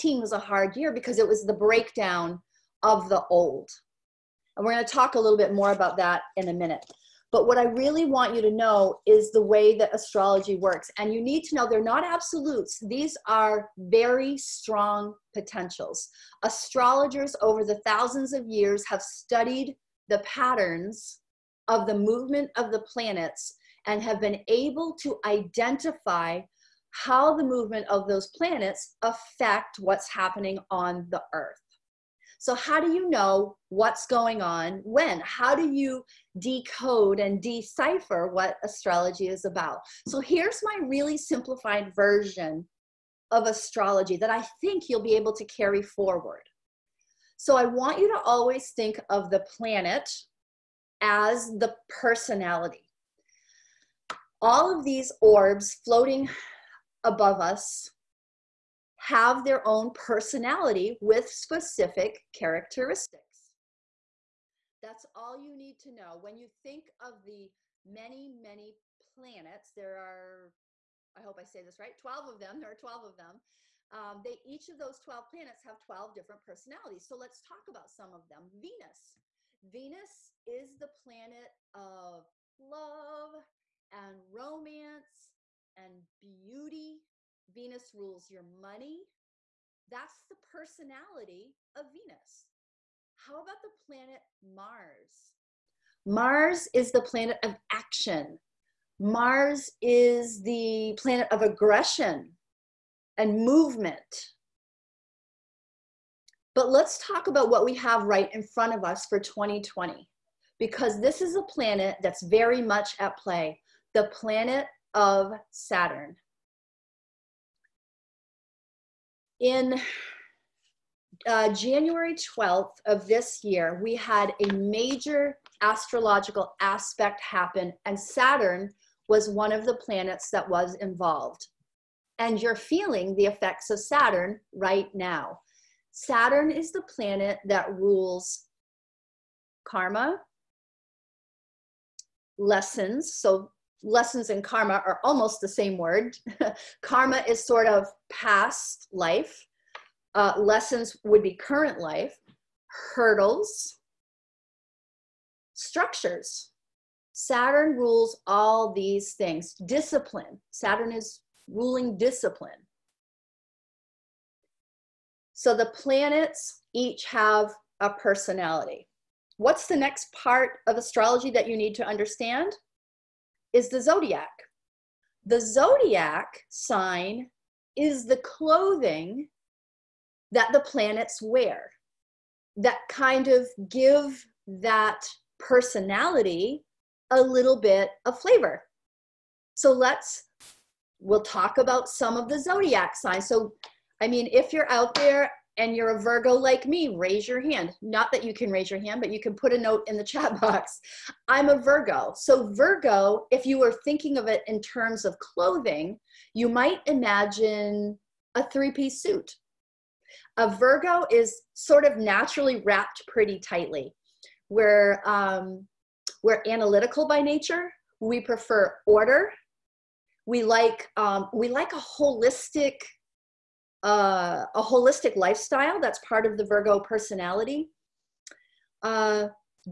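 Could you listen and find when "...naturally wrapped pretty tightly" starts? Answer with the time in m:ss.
3:31.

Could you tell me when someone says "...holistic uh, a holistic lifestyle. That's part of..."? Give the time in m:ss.
3:41.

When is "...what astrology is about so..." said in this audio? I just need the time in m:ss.
0:38.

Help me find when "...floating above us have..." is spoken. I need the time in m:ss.
0:55.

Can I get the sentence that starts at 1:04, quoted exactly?
That's all you need to know.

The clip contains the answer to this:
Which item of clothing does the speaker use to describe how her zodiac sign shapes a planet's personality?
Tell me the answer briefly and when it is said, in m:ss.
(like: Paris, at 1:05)
three piece suit, at 3:28.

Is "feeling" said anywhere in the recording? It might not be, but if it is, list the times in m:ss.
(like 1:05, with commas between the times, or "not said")
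2:12.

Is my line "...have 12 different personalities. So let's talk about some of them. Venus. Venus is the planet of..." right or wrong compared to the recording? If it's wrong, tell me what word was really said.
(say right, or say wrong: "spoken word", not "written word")
right.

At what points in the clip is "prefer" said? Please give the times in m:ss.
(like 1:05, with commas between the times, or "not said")
3:38.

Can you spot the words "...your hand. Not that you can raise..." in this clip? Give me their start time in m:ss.
3:17.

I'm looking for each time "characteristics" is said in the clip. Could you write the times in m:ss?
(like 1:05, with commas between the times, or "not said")
1:02.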